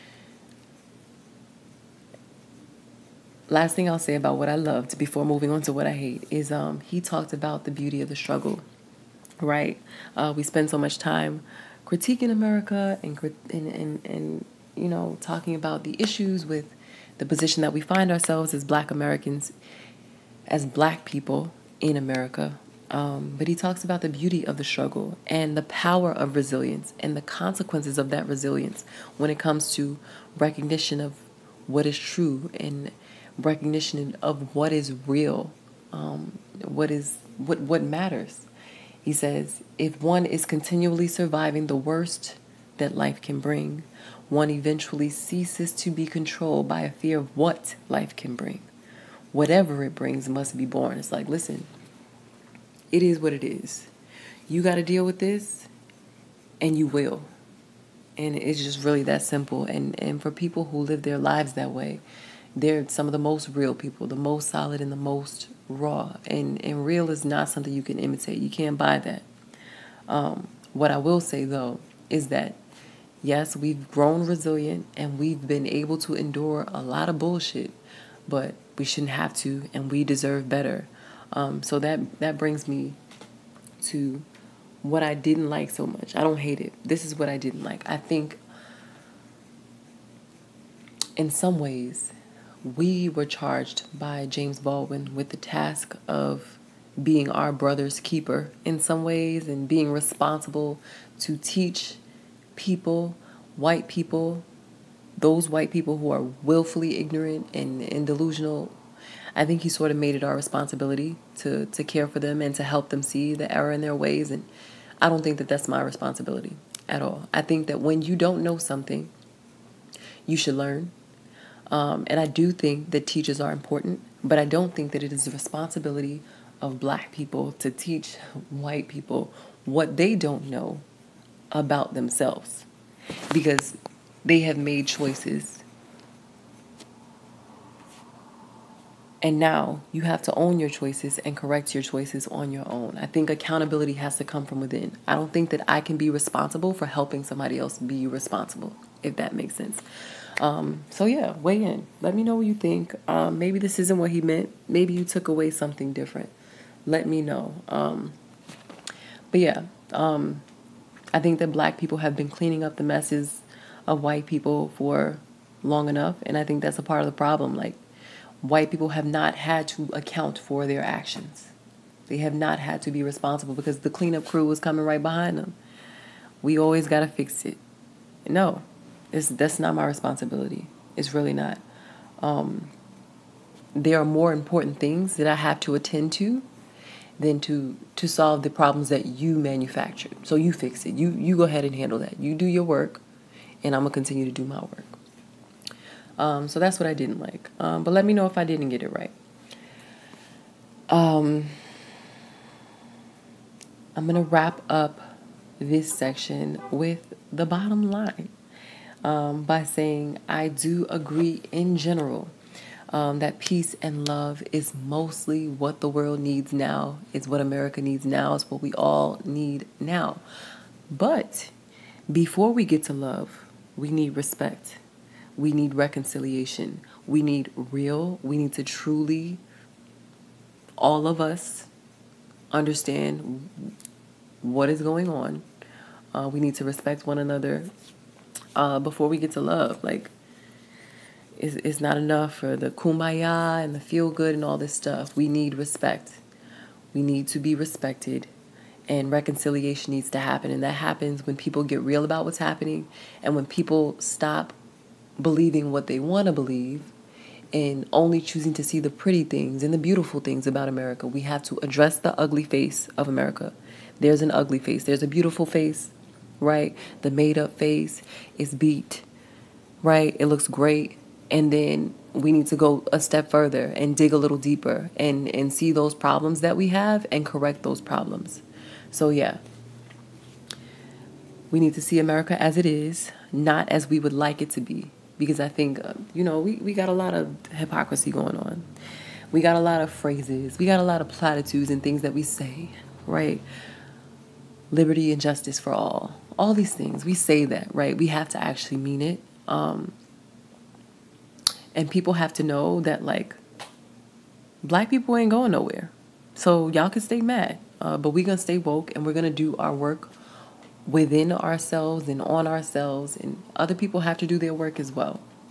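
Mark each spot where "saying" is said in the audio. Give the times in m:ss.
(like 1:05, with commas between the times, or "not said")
3:29.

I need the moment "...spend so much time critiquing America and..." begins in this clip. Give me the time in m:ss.
0:10.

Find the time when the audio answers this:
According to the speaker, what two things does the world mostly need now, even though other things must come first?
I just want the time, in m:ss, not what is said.
3:33.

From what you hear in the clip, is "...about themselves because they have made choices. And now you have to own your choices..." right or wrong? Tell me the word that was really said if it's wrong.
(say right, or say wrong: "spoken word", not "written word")
right.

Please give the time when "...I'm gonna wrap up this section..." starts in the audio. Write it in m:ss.
3:23.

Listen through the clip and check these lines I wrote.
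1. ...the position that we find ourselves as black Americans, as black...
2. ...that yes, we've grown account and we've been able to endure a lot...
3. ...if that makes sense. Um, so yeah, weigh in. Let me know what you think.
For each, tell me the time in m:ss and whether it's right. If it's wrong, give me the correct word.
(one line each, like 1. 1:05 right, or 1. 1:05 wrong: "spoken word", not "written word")
1. 0:17 right
2. 1:12 wrong: "resilient", not "account"
3. 2:29 right.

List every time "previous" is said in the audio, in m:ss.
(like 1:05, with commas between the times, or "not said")
not said.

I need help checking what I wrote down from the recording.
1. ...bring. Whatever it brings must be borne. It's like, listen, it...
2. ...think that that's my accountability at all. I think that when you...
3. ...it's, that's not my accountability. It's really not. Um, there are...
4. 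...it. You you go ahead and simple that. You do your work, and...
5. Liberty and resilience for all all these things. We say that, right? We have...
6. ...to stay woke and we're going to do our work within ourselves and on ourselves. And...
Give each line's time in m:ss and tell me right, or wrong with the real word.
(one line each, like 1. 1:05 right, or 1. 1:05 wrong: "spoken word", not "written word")
1. 0:48 right
2. 1:55 wrong: "responsibility", not "accountability"
3. 2:59 wrong: "responsibility", not "accountability"
4. 3:10 wrong: "handle", not "simple"
5. 4:54 wrong: "justice", not "resilience"
6. 5:08 right.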